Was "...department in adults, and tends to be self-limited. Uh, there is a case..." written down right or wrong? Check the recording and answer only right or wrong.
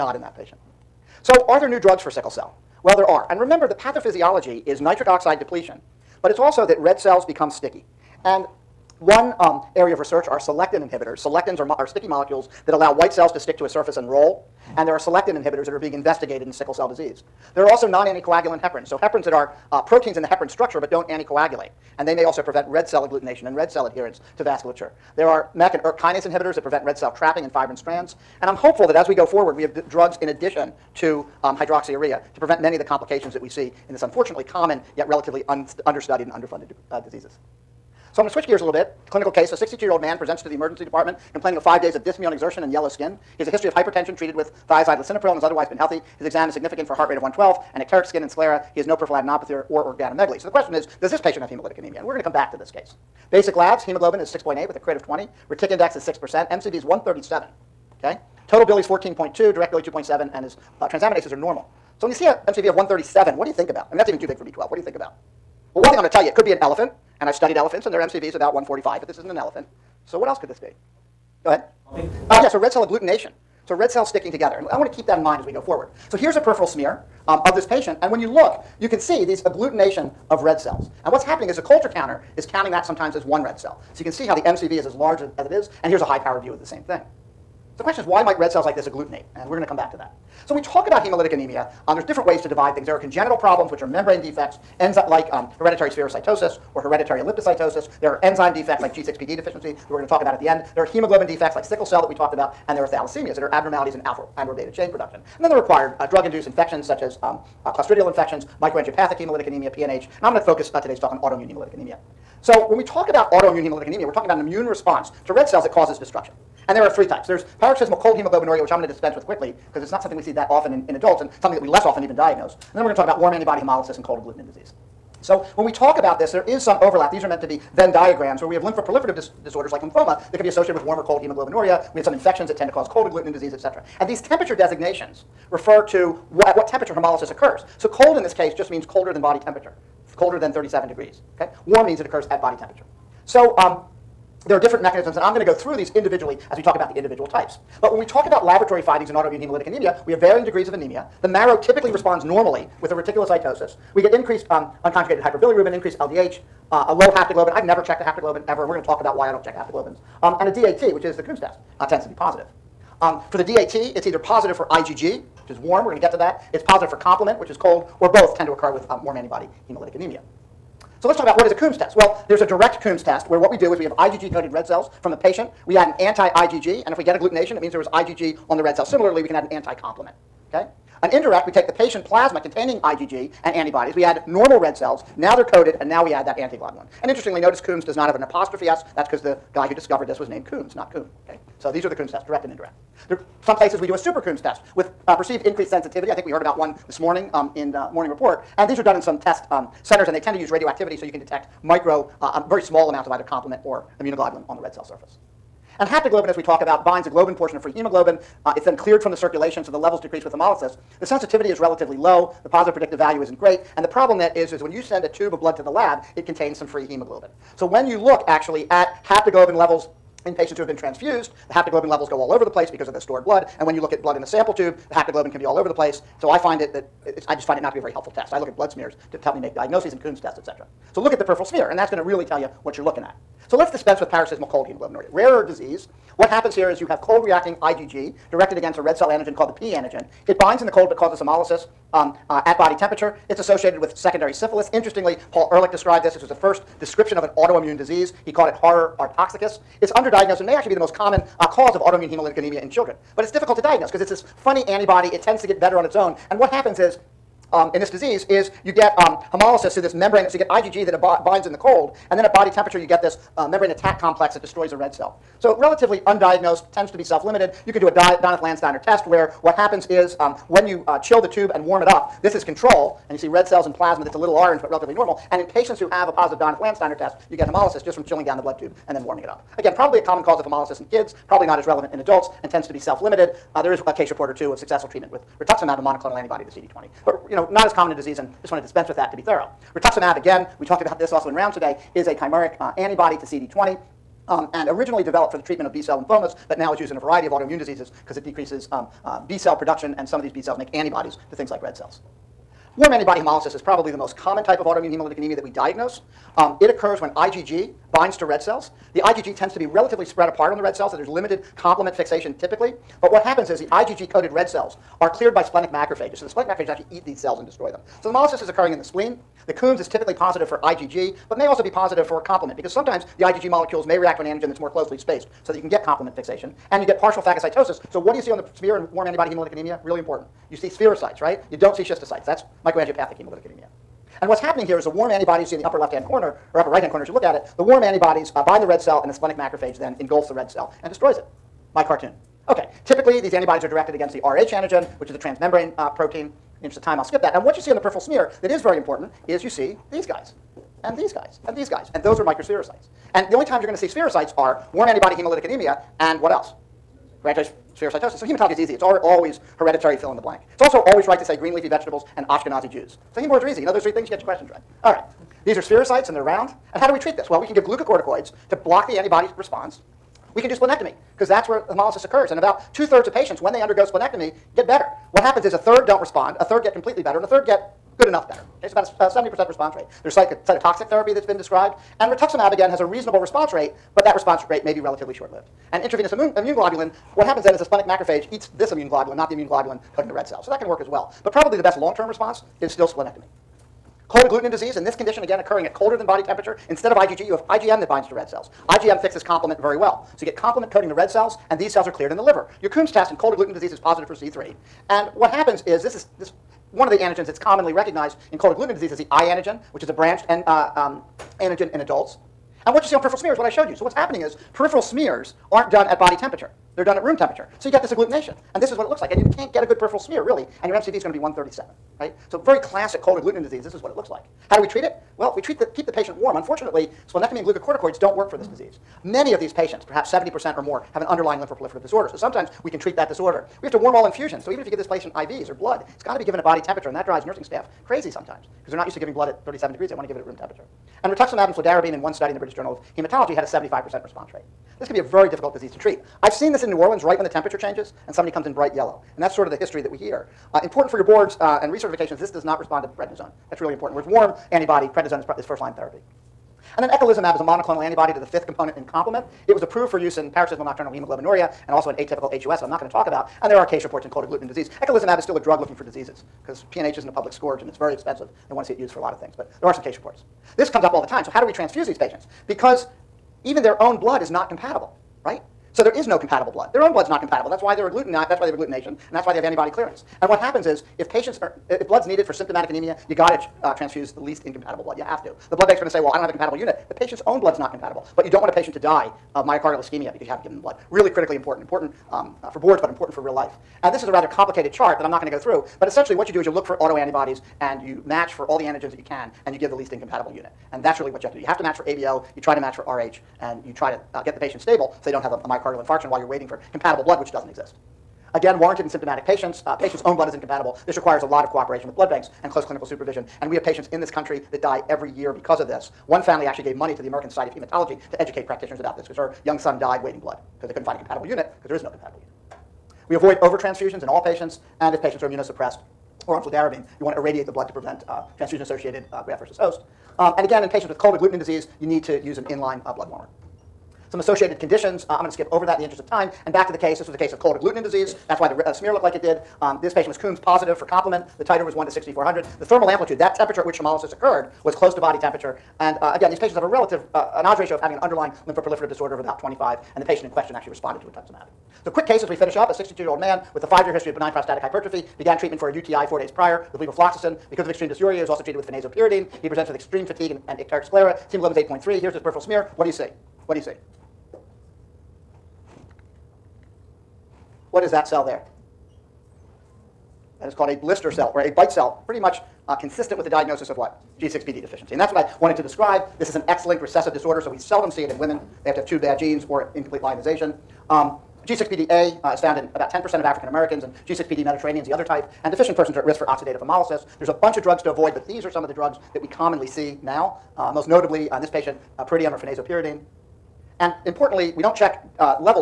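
wrong.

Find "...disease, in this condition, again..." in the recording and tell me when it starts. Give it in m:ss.
6:34.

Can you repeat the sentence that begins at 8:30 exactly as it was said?
This requires a lot of cooperation with blood banks and close clinical supervision.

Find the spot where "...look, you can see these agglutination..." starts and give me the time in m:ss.
1:18.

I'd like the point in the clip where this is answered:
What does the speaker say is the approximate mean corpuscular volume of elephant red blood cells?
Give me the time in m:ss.
1:08.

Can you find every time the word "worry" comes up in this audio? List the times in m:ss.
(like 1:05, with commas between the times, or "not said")
not said.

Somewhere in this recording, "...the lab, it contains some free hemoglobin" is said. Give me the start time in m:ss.
3:35.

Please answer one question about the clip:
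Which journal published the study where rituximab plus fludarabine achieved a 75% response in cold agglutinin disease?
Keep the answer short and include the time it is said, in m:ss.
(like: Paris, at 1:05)
British Journal of Hematology, at 7:22.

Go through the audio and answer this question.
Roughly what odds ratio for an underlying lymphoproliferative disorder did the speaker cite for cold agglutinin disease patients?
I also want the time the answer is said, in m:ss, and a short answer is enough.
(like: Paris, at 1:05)
25, at 9:09.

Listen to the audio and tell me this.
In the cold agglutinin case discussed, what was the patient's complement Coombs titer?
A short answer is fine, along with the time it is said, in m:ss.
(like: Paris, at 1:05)
1 to 6,400, at 9:01.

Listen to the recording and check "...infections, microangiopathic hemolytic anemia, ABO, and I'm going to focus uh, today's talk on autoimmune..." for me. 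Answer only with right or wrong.
wrong.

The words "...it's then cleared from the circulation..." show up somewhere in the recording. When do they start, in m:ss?
3:28.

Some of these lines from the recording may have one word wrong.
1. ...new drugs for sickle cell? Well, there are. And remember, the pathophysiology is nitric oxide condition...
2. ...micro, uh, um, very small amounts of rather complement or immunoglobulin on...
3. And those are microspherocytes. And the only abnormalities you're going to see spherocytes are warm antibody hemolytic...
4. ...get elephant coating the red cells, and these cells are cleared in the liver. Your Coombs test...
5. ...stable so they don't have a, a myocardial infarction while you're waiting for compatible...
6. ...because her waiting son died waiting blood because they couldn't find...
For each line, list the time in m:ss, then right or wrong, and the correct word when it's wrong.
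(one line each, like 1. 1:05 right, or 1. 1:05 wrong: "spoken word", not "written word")
1. 0:01 wrong: "depletion", not "condition"
2. 3:21 wrong: "either", not "rather"
3. 5:51 wrong: "times", not "abnormalities"
4. 6:40 wrong: "complement", not "elephant"
5. 8:24 right
6. 8:39 wrong: "young", not "waiting".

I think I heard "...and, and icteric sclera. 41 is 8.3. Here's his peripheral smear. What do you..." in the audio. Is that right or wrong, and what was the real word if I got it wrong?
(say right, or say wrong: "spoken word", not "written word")
wrong: "11", not "41".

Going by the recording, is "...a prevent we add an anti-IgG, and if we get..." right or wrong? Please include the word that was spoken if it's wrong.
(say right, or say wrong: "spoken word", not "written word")
wrong: "patient", not "prevent".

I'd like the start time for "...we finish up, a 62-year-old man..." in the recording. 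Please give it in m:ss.
9:12.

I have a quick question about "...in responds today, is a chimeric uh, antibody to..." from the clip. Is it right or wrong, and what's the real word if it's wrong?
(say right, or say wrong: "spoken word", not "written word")
wrong: "rounds", not "responds".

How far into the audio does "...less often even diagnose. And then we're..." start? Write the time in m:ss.
2:01.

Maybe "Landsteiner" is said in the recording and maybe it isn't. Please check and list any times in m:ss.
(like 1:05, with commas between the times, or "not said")
4:27, 4:36.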